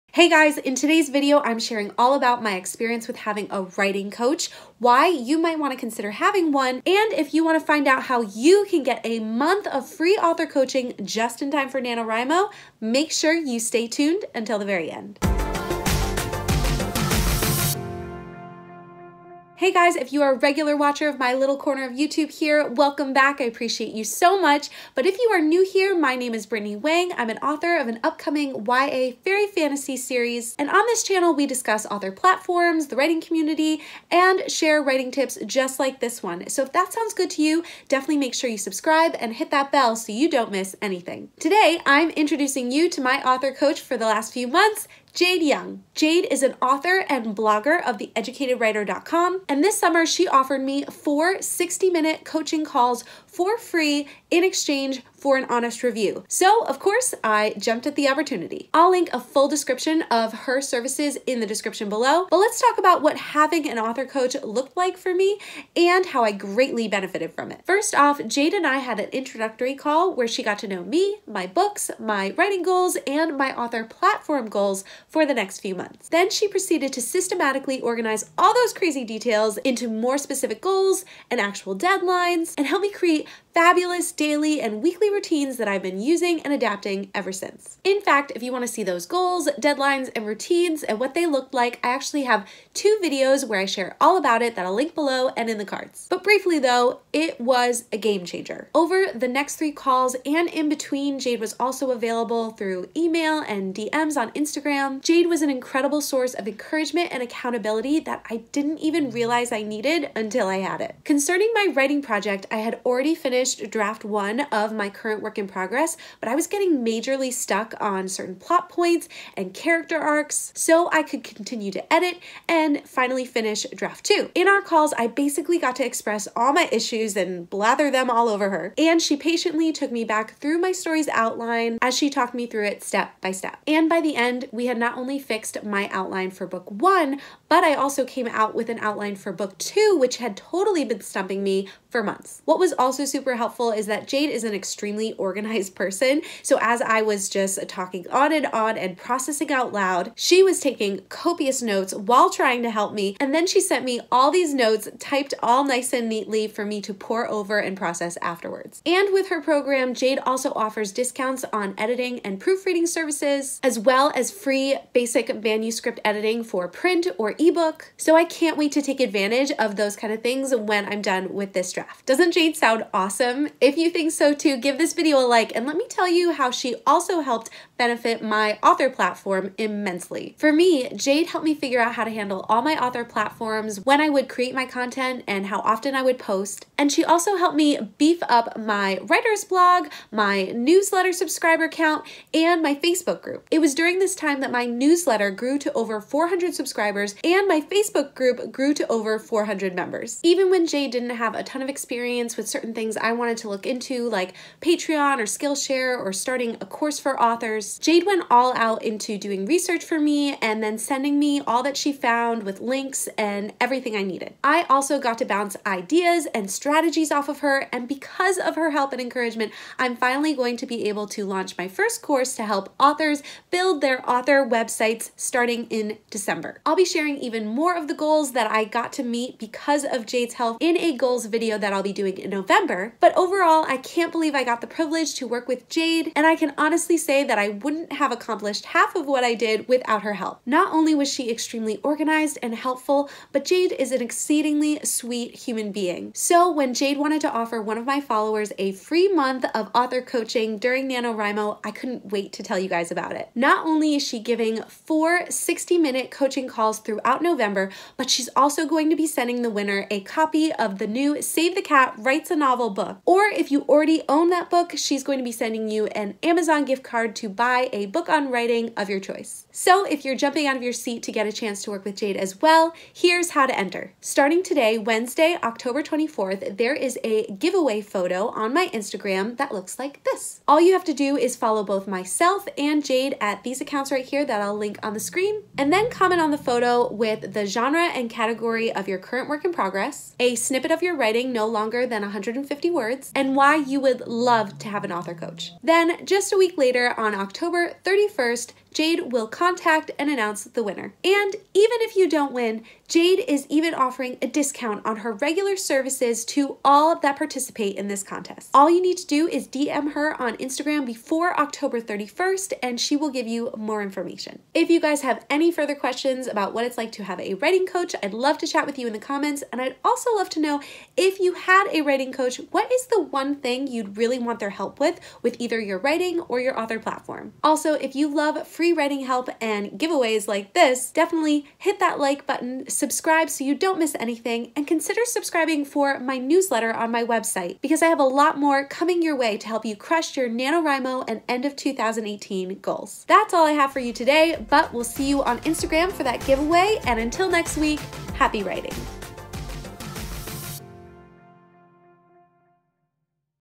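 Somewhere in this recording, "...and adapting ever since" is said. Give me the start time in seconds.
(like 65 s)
86 s.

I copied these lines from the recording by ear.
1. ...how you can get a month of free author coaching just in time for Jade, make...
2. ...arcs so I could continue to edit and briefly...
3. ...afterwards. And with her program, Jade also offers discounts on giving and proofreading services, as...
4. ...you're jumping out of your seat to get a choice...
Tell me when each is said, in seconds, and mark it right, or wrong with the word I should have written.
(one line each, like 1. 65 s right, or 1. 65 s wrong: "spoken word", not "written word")
1. 8 s wrong: "NaNoWriMo", not "Jade"
2. 119 s wrong: "finally", not "briefly"
3. 158 s wrong: "editing", not "giving"
4. 270 s wrong: "chance", not "choice".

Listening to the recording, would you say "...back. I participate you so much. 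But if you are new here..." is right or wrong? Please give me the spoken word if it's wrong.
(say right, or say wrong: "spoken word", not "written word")
wrong: "appreciate", not "participate".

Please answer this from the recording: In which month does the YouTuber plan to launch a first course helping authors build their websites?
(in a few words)
December.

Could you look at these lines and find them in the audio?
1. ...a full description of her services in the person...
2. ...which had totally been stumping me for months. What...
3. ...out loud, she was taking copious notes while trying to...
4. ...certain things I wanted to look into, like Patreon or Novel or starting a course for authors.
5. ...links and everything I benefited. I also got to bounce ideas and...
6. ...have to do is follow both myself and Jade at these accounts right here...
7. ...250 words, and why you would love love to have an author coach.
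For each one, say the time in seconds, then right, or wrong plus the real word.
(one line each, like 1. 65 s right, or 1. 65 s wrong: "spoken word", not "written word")
1. 59 s wrong: "description", not "person"
2. 139 s right
3. 149 s right
4. 202 s wrong: "Skillshare", not "Novel"
5. 212 s wrong: "needed", not "benefited"
6. 280 s right
7. 292 s wrong: "150", not "250".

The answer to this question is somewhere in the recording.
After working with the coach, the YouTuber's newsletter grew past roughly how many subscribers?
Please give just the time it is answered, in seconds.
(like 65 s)
195 s.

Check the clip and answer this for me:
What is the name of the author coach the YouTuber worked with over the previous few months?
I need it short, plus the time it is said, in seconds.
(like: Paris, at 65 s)
Jade Young, at 45 s.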